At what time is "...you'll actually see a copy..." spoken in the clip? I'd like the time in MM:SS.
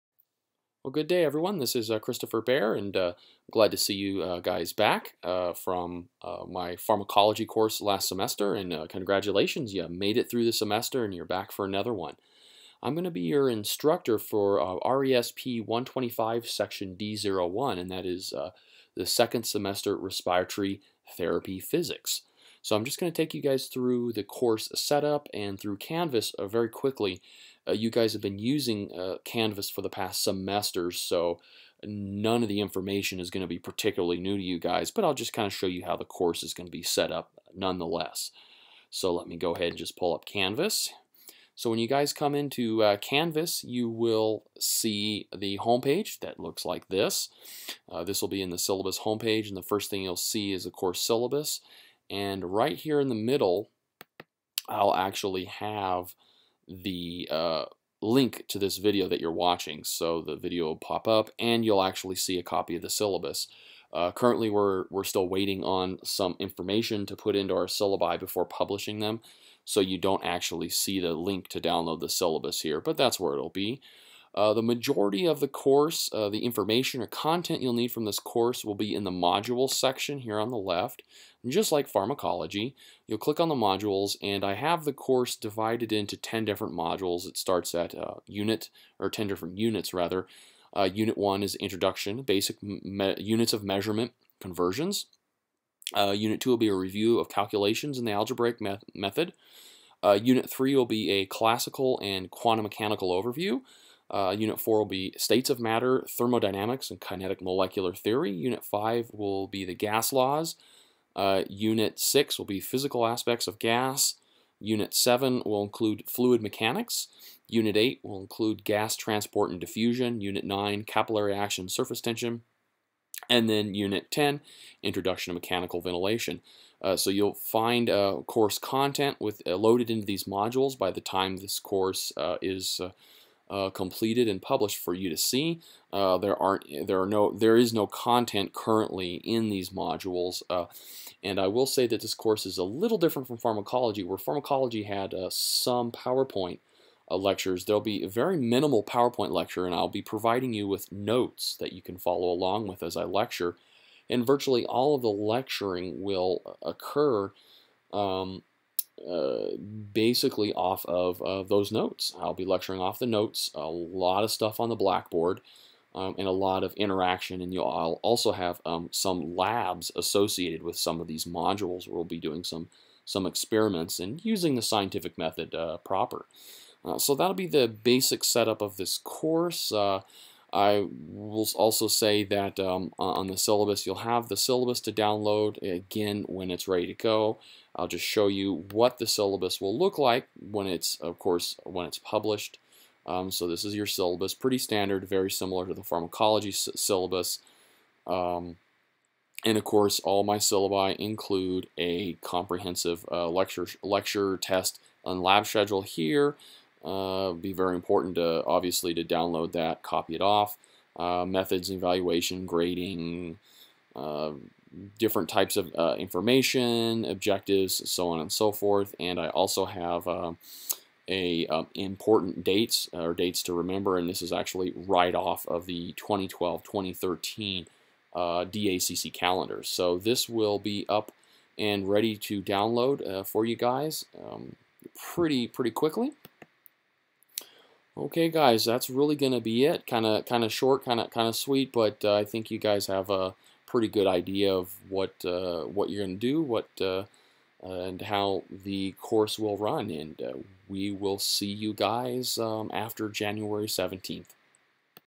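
01:01.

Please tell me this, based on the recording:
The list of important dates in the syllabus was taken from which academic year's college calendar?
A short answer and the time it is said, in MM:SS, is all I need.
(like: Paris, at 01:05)
2012-2013, at 03:45.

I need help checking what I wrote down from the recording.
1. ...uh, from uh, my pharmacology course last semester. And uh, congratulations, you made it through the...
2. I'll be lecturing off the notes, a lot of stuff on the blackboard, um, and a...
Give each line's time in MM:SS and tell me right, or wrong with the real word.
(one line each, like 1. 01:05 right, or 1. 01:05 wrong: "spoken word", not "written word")
1. 00:05 right
2. 02:42 right.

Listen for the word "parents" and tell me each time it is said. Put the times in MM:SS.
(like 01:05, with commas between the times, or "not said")
not said.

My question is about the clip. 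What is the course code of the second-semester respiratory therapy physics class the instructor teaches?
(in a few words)
RESP 125.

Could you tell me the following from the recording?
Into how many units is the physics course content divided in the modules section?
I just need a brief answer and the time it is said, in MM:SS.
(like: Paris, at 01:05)
10, at 01:29.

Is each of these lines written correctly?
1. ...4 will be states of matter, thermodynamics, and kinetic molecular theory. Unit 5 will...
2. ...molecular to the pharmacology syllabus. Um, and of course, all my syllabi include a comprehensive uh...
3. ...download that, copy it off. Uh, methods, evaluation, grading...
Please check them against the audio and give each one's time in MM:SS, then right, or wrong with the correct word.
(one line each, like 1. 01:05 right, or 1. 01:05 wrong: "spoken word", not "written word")
1. 01:44 right
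2. 03:15 wrong: "similar", not "molecular"
3. 03:29 right.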